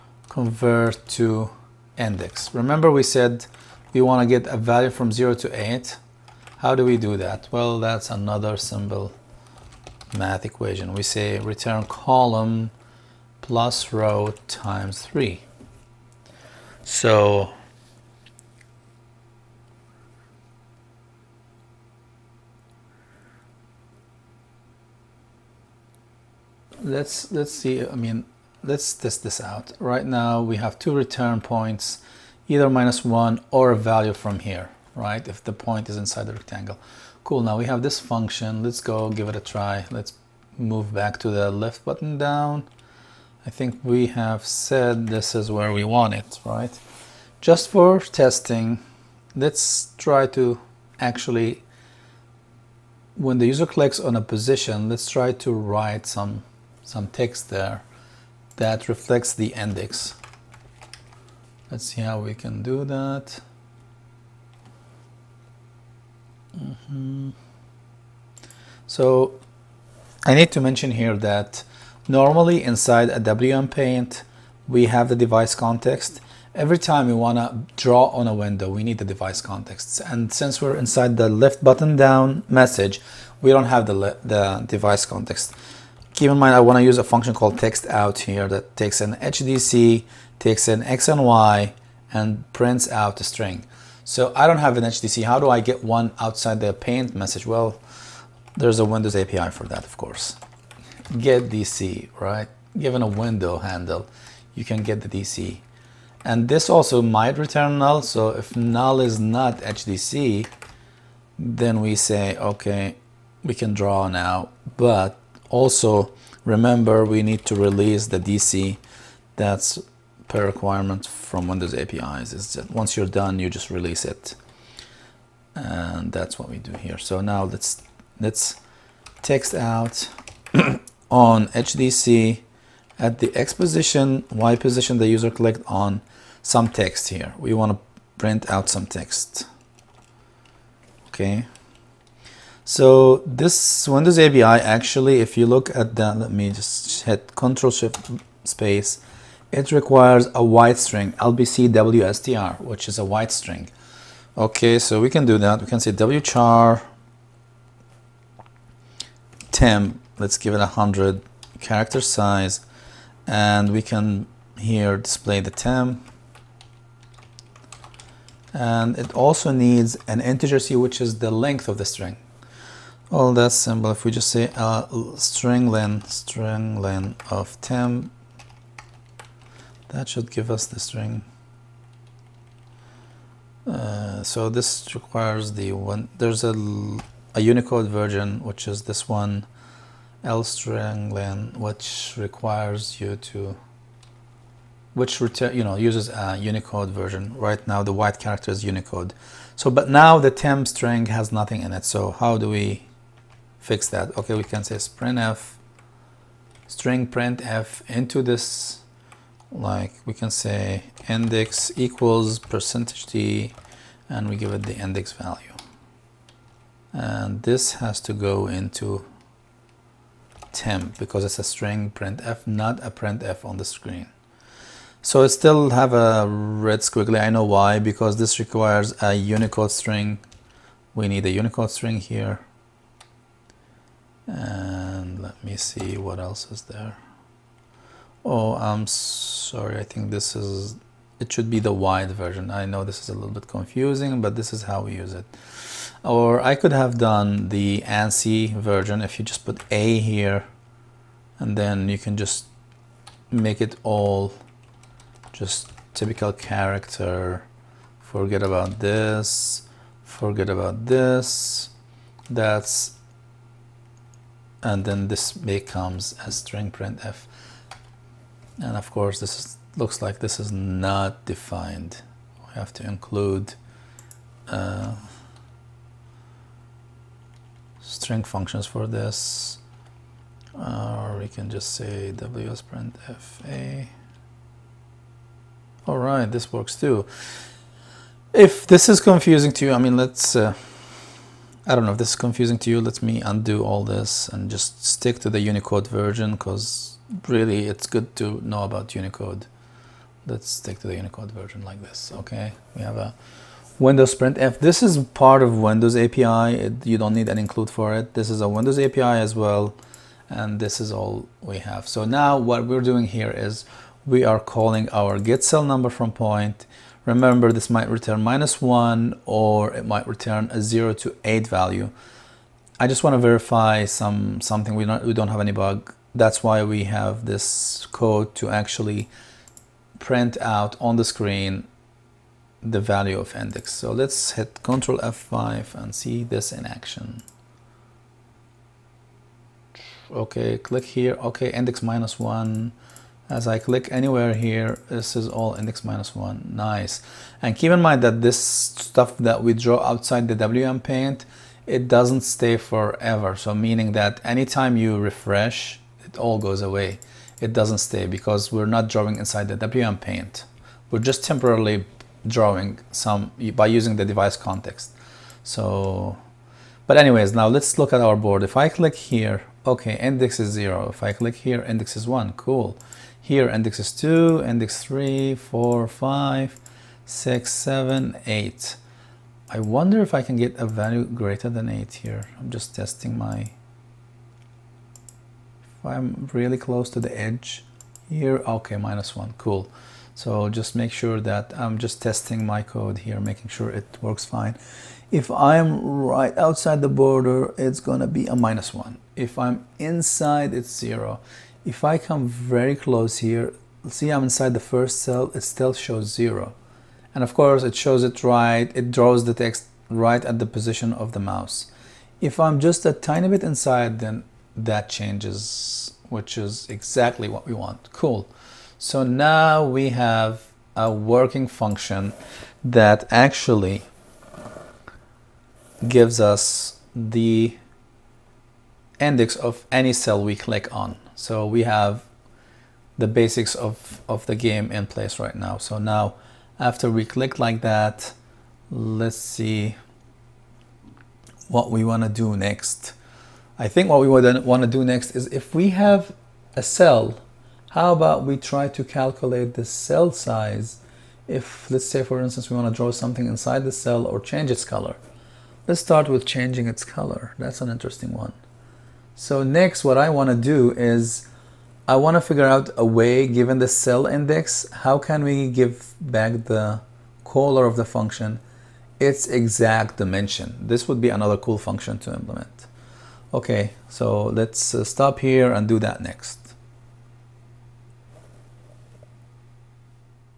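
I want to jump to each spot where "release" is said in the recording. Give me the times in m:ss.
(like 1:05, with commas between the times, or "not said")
1:57, 2:03.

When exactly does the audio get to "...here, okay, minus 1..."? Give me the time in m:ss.
6:28.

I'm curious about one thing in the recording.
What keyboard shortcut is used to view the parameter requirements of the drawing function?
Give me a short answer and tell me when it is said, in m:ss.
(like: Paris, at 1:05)
Control Shift space, at 2:27.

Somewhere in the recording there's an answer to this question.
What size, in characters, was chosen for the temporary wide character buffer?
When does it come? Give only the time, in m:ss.
2:40.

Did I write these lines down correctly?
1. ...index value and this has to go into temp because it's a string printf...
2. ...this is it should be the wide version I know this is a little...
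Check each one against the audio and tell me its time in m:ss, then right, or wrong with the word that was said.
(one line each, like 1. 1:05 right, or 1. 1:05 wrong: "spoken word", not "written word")
1. 3:34 right
2. 4:00 right.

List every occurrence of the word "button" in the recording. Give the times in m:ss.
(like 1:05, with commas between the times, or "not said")
0:41, 1:21.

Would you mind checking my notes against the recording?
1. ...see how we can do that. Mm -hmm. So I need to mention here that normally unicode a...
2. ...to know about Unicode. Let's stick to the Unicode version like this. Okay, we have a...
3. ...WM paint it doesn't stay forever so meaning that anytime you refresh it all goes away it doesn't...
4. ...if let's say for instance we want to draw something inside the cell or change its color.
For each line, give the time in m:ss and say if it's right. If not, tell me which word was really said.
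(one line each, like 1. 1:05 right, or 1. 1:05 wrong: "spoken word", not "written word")
1. 1:01 wrong: "inside", not "unicode"
2. 4:58 right
3. 5:50 right
4. 7:31 right.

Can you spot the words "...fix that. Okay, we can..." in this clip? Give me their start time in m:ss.
3:23.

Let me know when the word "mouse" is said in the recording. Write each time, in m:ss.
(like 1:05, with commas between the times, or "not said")
6:51.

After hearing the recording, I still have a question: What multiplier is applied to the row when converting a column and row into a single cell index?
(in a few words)
3.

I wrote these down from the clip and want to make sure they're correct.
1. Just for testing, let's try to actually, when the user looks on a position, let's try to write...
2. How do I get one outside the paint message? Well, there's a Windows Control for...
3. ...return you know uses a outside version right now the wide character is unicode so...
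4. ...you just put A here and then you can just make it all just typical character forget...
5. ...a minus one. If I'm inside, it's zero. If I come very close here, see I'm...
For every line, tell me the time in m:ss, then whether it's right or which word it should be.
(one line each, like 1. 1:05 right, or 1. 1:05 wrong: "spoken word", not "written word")
1. 0:47 wrong: "clicks", not "looks"
2. 1:35 wrong: "API", not "Control"
3. 3:15 wrong: "unicode", not "outside"
4. 4:09 right
5. 6:38 right.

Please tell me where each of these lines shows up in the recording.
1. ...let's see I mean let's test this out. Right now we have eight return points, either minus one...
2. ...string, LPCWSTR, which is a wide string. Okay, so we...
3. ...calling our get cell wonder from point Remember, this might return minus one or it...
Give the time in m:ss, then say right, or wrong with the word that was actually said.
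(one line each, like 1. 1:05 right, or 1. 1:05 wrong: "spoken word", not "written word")
1. 0:27 wrong: "two", not "eight"
2. 2:30 right
3. 5:14 wrong: "number", not "wonder".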